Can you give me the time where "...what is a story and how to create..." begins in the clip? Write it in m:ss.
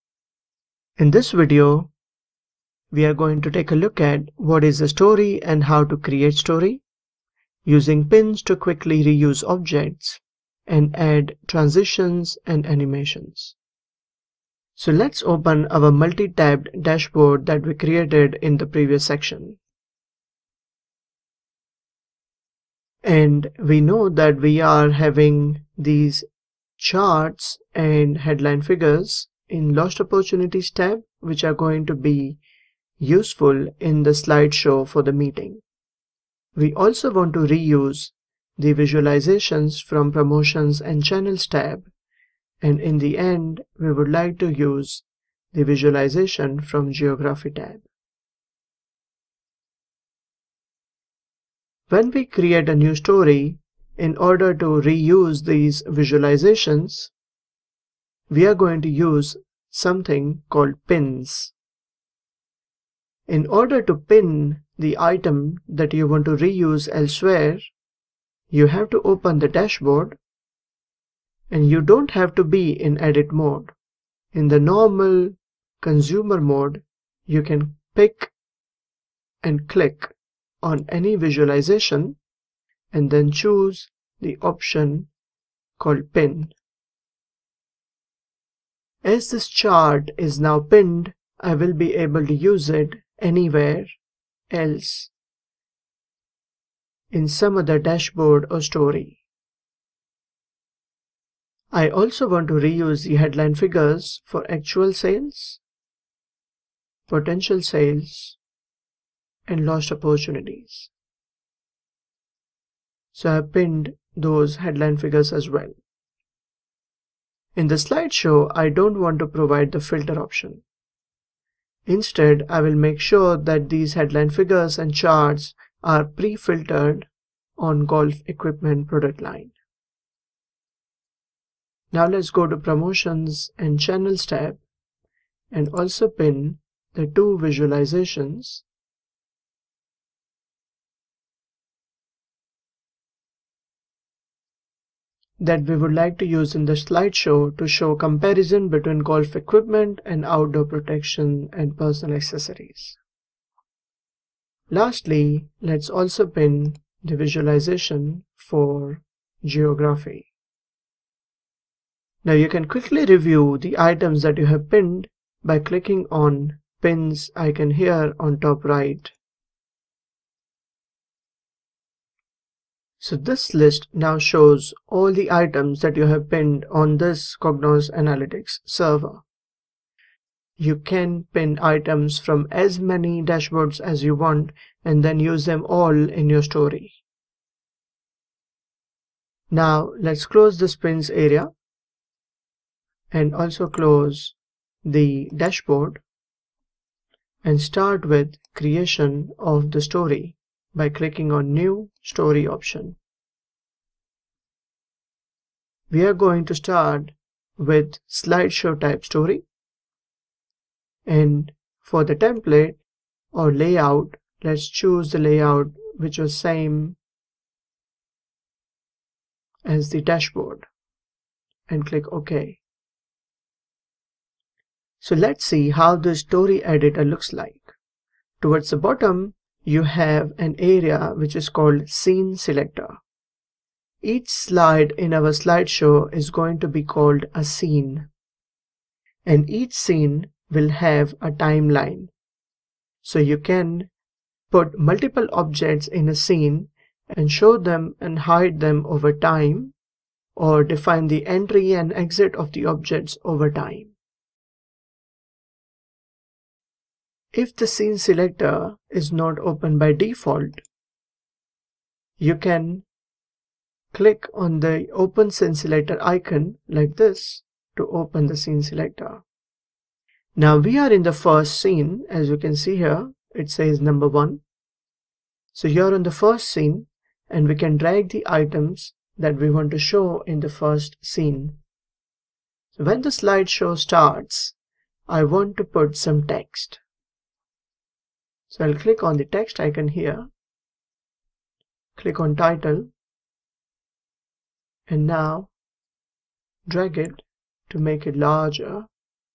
0:04.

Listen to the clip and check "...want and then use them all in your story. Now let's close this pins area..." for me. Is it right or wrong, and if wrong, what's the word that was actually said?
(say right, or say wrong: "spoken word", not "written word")
right.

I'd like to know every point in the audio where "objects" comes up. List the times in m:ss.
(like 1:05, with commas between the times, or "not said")
0:09, 4:05, 4:12.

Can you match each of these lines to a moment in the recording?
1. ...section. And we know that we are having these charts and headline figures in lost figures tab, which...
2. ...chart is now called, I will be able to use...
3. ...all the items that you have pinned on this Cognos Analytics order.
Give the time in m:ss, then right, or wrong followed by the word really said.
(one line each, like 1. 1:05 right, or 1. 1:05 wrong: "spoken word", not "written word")
1. 0:19 wrong: "opportunities", not "figures"
2. 1:29 wrong: "pinned", not "called"
3. 2:54 wrong: "server", not "order".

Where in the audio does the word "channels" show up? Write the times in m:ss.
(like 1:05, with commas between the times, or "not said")
0:41, 2:13.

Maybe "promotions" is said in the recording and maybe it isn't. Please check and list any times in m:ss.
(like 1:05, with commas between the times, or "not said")
0:40, 2:12.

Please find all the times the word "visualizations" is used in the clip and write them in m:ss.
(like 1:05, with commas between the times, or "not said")
0:38, 0:45, 0:55, 1:21, 2:17, 2:37.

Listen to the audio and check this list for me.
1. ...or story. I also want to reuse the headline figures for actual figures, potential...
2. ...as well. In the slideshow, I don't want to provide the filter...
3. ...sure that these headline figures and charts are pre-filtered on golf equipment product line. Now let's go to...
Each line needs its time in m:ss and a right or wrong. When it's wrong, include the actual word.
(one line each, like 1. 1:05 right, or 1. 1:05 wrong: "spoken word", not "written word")
1. 1:38 wrong: "sales", not "figures"
2. 1:55 right
3. 2:02 right.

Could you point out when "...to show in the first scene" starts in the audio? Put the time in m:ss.
4:39.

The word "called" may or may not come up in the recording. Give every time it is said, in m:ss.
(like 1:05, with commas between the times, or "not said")
1:00, 1:25, 3:51, 3:56.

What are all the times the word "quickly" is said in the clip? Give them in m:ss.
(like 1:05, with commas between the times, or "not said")
0:08, 2:42.